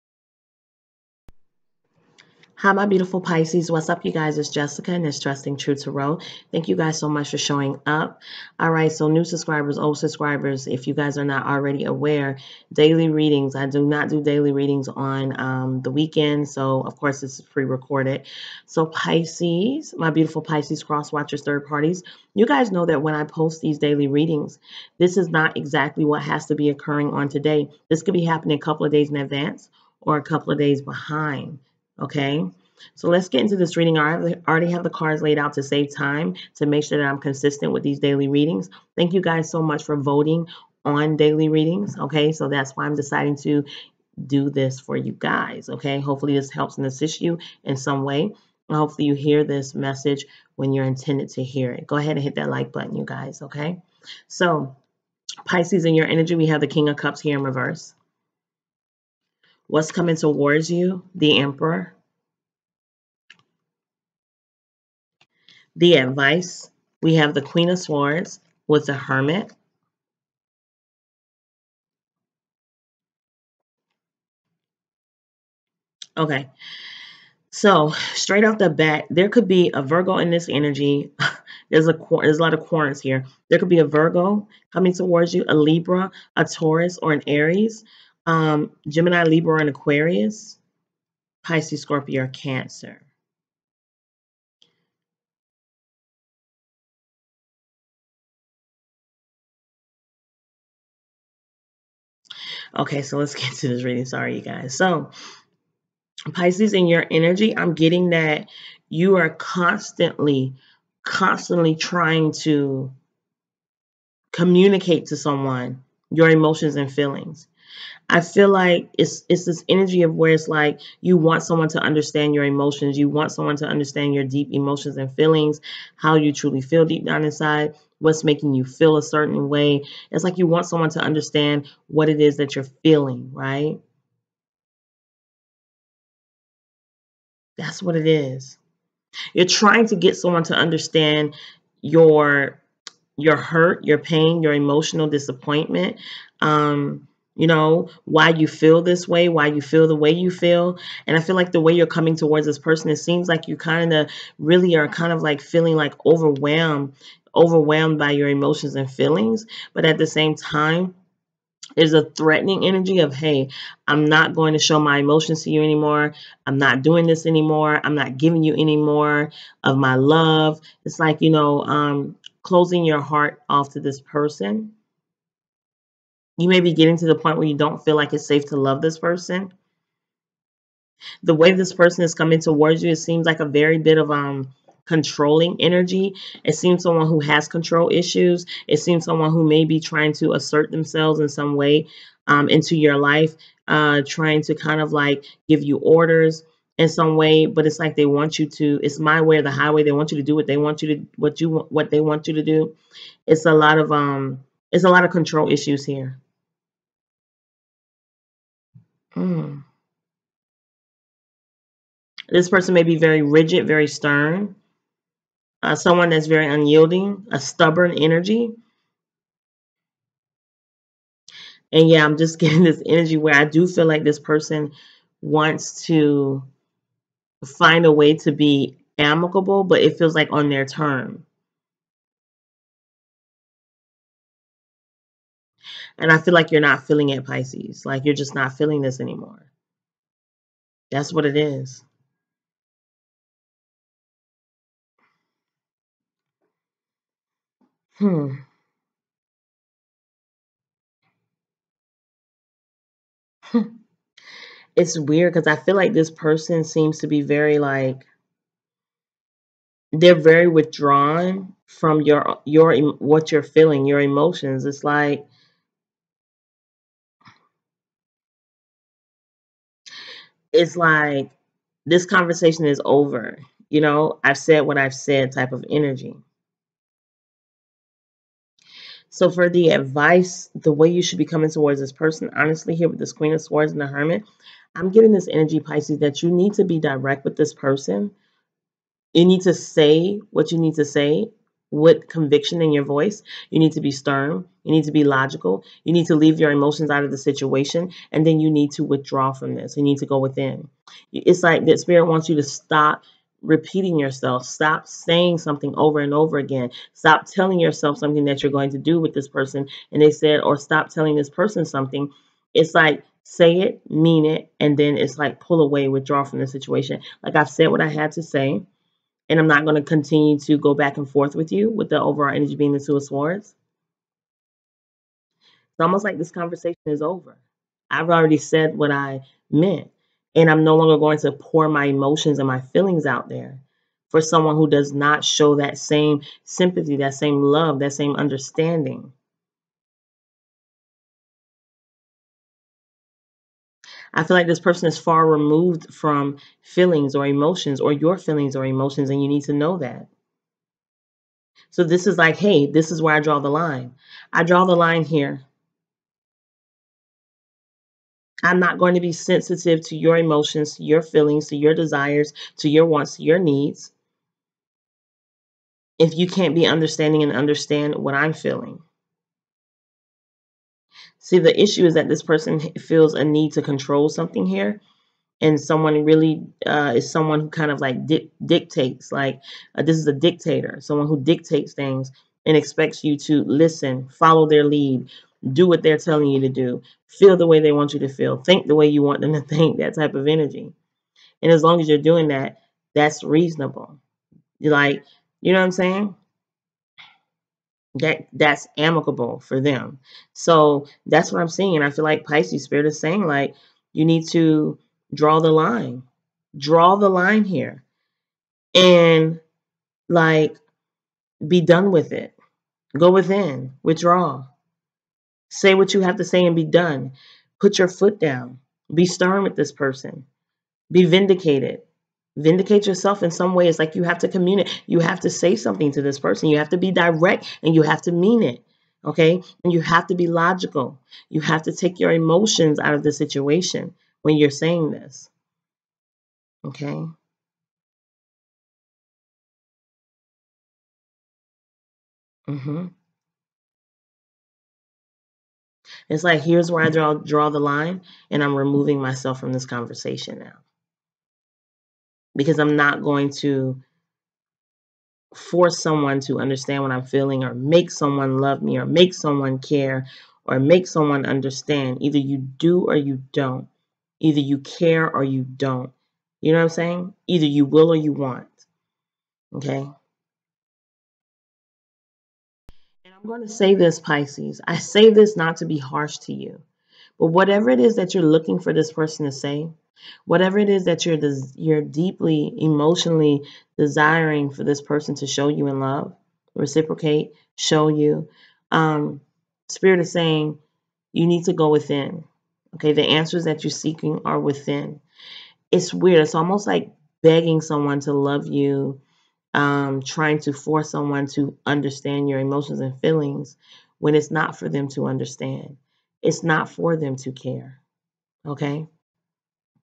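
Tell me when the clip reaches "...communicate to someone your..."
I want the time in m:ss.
1:54.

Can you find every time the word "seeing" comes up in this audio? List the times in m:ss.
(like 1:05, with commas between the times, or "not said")
6:41.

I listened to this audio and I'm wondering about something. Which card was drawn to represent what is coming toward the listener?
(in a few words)
The Emperor.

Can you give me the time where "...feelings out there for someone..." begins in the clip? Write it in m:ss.
5:32.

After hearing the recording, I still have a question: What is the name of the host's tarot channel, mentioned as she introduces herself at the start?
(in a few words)
Trusting Truth Tarot.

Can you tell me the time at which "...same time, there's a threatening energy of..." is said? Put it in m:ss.
2:40.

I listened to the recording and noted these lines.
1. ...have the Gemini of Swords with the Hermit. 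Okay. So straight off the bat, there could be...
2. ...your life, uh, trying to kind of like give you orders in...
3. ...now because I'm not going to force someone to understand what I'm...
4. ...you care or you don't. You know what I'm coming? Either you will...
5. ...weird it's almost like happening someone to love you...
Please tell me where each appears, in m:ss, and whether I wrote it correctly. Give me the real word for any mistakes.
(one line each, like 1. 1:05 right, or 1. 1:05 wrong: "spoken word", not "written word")
1. 1:07 wrong: "Queen", not "Gemini"
2. 3:12 right
3. 7:30 right
4. 7:44 wrong: "saying", not "coming"
5. 8:15 wrong: "begging", not "happening".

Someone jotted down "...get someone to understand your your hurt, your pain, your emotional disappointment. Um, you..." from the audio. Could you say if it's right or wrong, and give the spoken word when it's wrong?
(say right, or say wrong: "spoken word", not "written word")
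right.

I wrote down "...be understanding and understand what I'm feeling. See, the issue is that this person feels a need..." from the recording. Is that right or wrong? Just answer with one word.
right.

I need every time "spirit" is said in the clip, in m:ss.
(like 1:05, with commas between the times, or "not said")
5:01, 6:42, 8:09.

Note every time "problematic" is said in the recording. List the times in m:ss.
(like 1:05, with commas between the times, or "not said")
not said.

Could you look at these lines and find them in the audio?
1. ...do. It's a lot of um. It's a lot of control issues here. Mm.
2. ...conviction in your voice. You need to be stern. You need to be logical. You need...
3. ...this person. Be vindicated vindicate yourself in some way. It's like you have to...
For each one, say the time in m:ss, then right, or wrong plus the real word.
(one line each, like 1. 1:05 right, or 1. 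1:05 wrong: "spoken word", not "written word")
1. 3:22 right
2. 4:52 right
3. 6:59 right.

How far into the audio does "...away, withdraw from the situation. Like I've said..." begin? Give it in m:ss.
5:15.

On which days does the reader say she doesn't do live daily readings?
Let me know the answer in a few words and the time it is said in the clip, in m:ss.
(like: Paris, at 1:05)
the weekend, at 0:15.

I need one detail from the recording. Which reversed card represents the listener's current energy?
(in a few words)
King of Cups.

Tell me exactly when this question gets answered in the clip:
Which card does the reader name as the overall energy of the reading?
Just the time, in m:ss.
5:22.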